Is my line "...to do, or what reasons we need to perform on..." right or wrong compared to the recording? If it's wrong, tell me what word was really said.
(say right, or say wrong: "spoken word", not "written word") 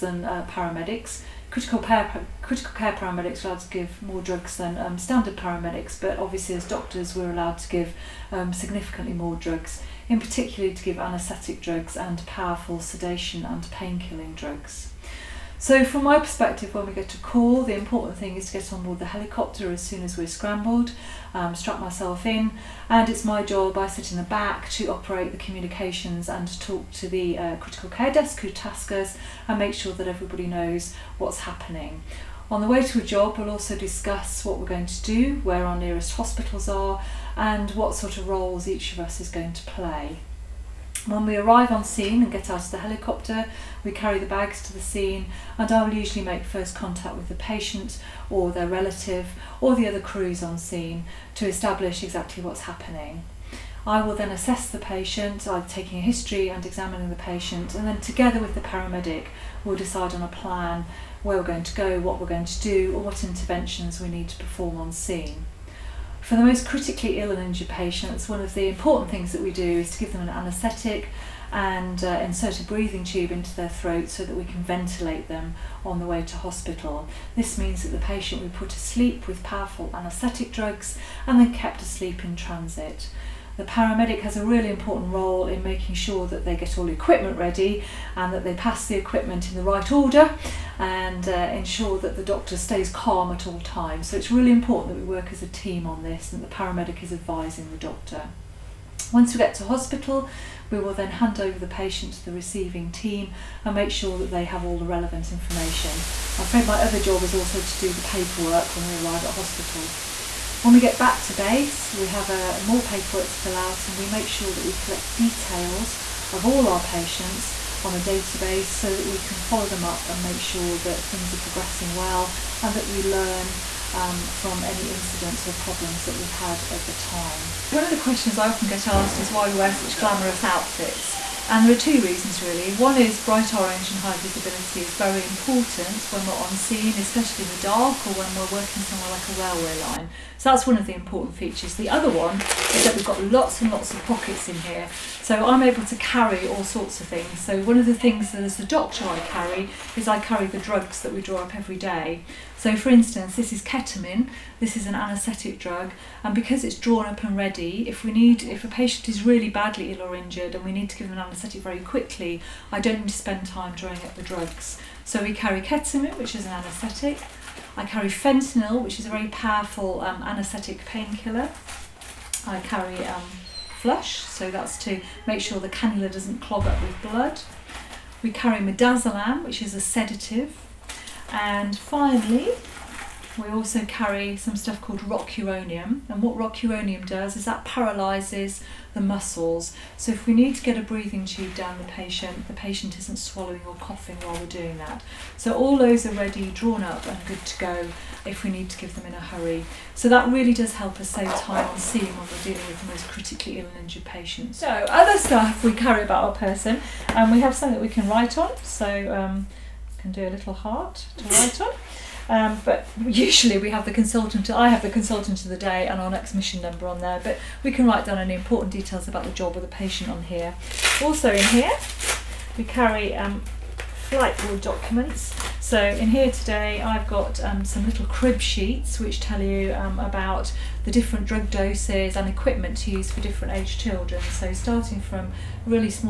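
wrong: "interventions", not "reasons".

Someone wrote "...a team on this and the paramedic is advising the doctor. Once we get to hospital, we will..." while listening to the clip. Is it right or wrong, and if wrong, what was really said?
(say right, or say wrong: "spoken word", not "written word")
right.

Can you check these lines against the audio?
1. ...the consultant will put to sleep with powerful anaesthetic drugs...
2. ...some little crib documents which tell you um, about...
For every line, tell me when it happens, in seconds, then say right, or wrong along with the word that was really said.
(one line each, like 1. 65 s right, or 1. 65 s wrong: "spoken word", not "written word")
1. 77 s wrong: "patient", not "consultant"
2. 227 s wrong: "sheets", not "documents".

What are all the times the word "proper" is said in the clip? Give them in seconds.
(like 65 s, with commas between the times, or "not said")
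not said.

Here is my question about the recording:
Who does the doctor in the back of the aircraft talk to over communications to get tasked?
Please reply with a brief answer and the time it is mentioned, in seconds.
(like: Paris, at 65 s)
Critical care desk, at 27 s.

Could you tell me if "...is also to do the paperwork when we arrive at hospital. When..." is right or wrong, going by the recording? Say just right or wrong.
right.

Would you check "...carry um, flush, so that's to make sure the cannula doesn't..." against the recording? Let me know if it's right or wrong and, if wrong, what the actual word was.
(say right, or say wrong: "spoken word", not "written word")
right.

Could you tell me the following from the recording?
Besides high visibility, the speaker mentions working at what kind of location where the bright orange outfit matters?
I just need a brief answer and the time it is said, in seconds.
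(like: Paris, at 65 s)
A railway line, at 139 s.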